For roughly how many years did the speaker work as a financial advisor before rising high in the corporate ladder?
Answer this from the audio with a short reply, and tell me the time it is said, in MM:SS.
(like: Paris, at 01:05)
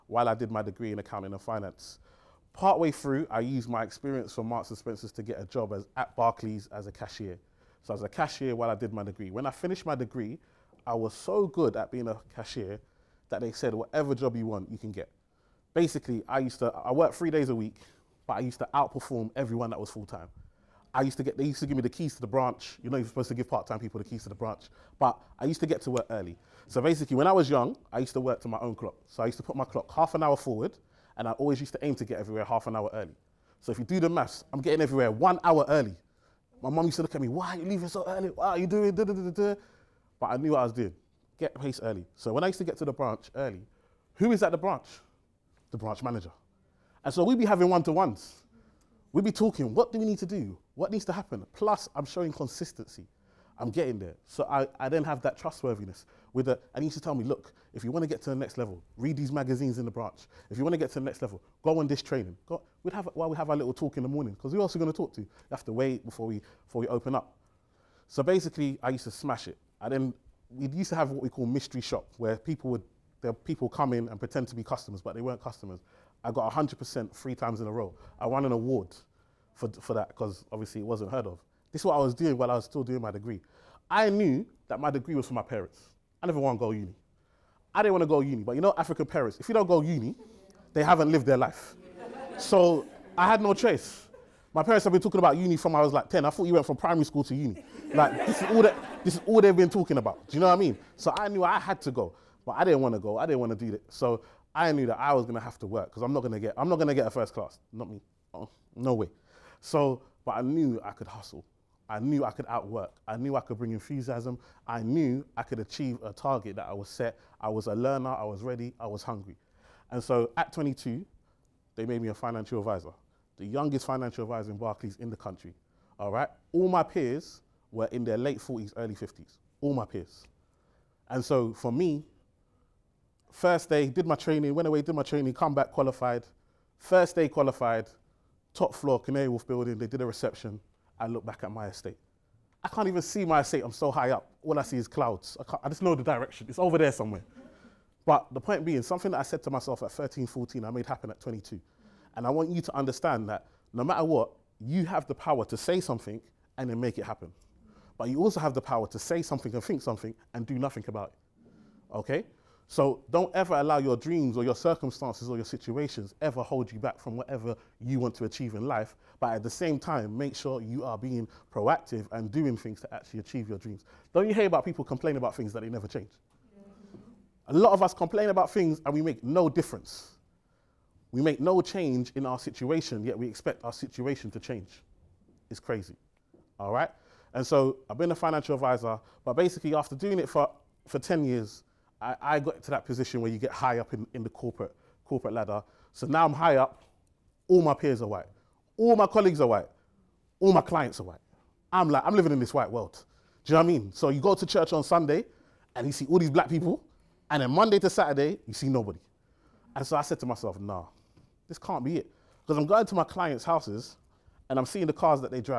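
10, at 03:10.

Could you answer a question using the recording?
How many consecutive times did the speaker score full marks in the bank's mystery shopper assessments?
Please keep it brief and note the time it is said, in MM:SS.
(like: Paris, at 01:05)
3, at 01:17.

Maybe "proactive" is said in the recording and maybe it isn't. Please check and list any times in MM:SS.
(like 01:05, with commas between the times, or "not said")
02:51.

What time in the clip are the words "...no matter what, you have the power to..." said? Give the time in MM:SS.
02:33.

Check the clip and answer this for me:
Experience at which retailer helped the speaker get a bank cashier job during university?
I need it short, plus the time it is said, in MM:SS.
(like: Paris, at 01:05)
Marks and Spencer's, at 00:04.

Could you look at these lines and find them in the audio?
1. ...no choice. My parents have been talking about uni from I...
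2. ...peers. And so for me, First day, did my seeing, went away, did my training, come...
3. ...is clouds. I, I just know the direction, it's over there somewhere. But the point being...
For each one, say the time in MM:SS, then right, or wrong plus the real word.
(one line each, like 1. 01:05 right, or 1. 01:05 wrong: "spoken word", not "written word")
1. 01:33 right
2. 02:09 wrong: "training", not "seeing"
3. 02:24 right.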